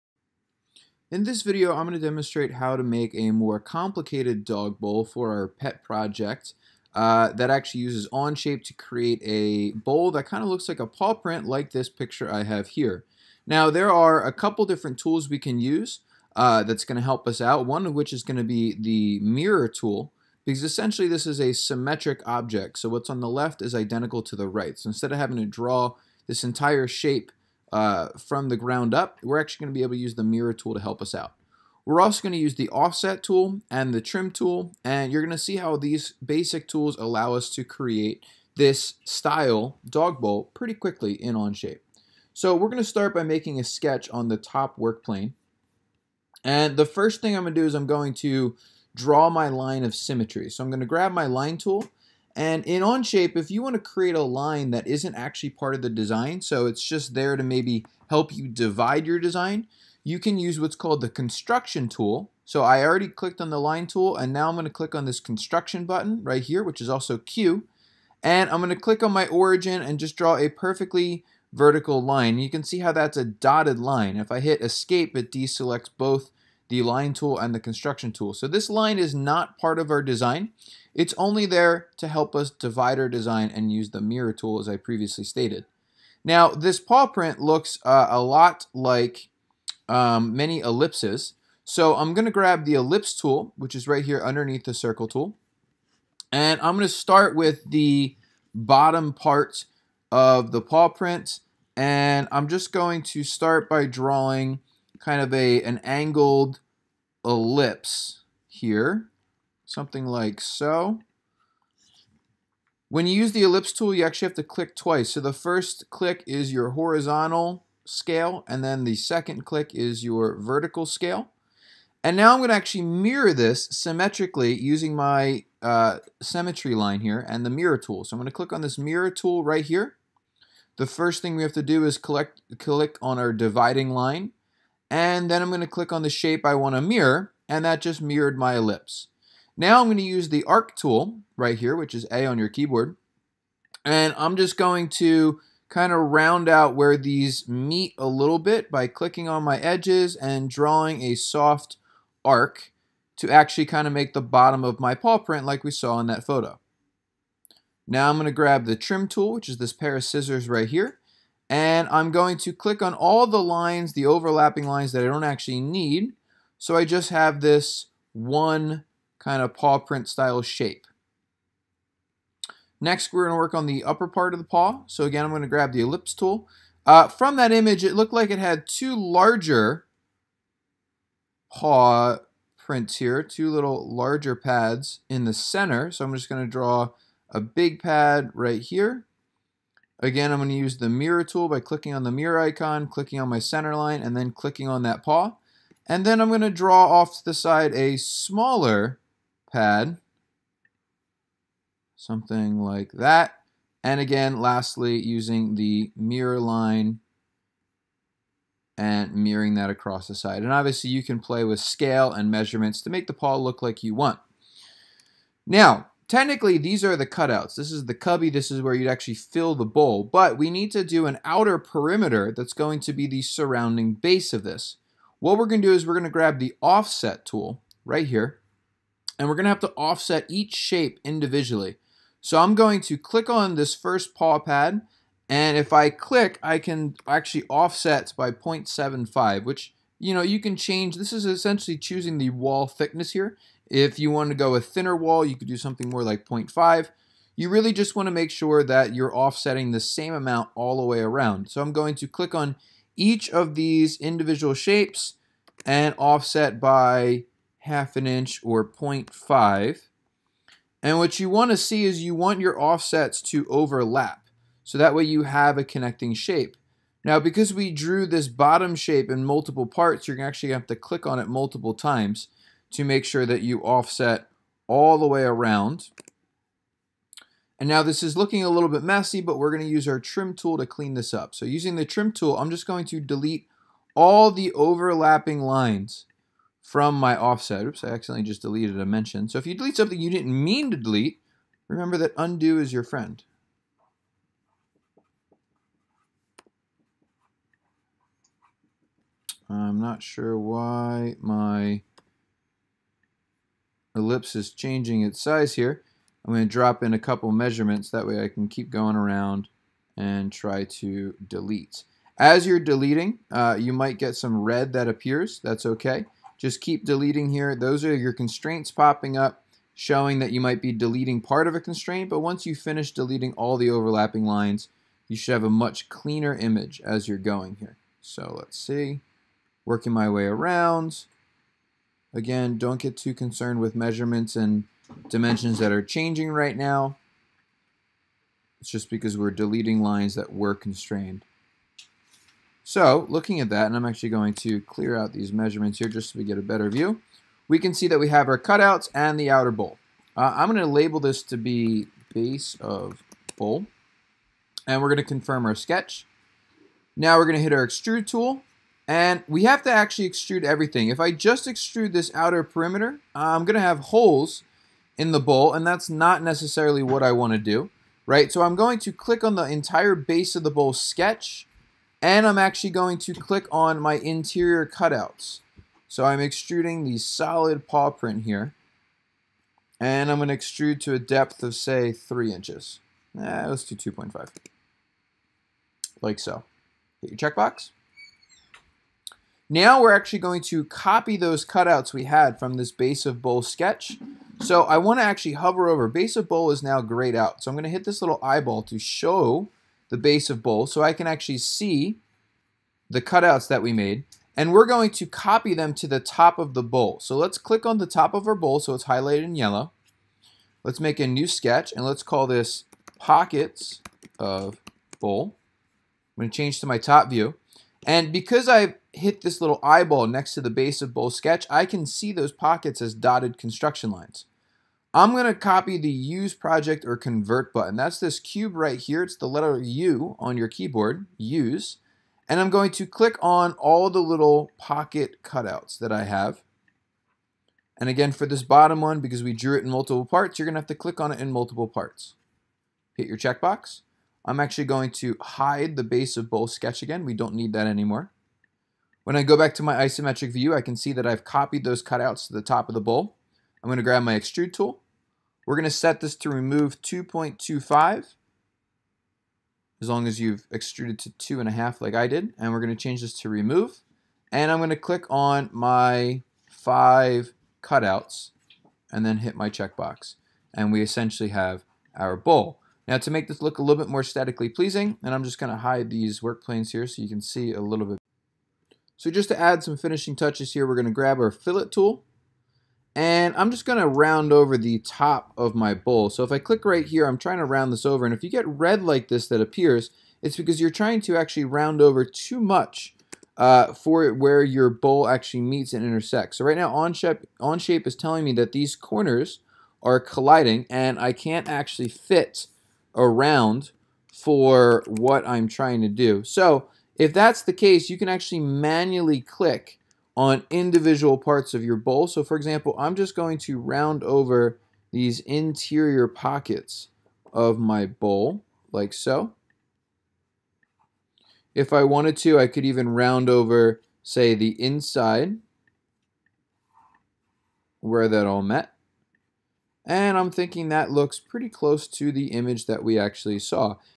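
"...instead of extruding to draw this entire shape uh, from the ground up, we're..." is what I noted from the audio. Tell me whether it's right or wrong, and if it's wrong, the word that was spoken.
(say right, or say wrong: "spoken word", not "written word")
wrong: "having", not "extruding".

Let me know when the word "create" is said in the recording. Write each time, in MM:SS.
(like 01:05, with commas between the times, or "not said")
00:08, 00:37, 00:53.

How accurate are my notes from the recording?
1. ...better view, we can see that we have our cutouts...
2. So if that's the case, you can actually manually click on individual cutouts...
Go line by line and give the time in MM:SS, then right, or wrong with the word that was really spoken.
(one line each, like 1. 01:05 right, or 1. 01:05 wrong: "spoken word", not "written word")
1. 05:46 right
2. 08:26 wrong: "parts", not "cutouts".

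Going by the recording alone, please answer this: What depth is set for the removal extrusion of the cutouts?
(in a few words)
2.25.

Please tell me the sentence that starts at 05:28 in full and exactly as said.
So let's see, working my way around.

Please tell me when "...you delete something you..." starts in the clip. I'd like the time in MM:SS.
04:49.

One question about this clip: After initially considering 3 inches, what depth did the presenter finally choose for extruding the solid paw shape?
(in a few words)
2.5 inches.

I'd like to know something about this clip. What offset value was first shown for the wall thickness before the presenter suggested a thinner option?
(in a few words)
0.75.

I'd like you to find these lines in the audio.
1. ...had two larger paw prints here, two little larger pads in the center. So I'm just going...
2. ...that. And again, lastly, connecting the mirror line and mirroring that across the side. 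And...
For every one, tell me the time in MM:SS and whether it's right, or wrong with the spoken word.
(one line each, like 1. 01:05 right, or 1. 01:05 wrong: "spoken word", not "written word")
1. 02:58 right
2. 03:22 wrong: "using", not "connecting".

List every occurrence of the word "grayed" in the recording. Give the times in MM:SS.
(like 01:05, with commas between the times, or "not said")
06:36.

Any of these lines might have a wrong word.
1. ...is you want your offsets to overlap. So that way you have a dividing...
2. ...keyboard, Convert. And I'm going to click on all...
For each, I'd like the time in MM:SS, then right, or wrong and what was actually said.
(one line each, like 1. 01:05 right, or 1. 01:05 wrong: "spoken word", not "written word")
1. 04:21 wrong: "connecting", not "dividing"
2. 07:10 wrong: "Use", not "Convert".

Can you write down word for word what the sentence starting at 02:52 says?
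Next, we're going to work on the upper part of the paw.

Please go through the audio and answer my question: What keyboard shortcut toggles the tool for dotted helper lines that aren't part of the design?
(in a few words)
Q.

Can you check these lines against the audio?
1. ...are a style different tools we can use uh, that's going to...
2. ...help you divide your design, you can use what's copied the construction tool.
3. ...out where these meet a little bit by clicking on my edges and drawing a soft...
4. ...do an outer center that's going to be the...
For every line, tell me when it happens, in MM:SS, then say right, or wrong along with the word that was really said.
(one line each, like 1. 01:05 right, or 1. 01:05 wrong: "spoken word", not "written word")
1. 00:13 wrong: "couple", not "style"
2. 00:58 wrong: "called", not "copied"
3. 02:26 right
4. 03:40 wrong: "perimeter", not "center".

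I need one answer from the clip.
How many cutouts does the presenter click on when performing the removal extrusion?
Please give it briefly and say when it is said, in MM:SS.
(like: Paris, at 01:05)
5, at 07:46.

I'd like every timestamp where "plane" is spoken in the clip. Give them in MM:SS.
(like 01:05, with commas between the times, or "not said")
00:45, 07:56.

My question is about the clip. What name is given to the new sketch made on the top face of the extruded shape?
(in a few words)
pockets of bowl.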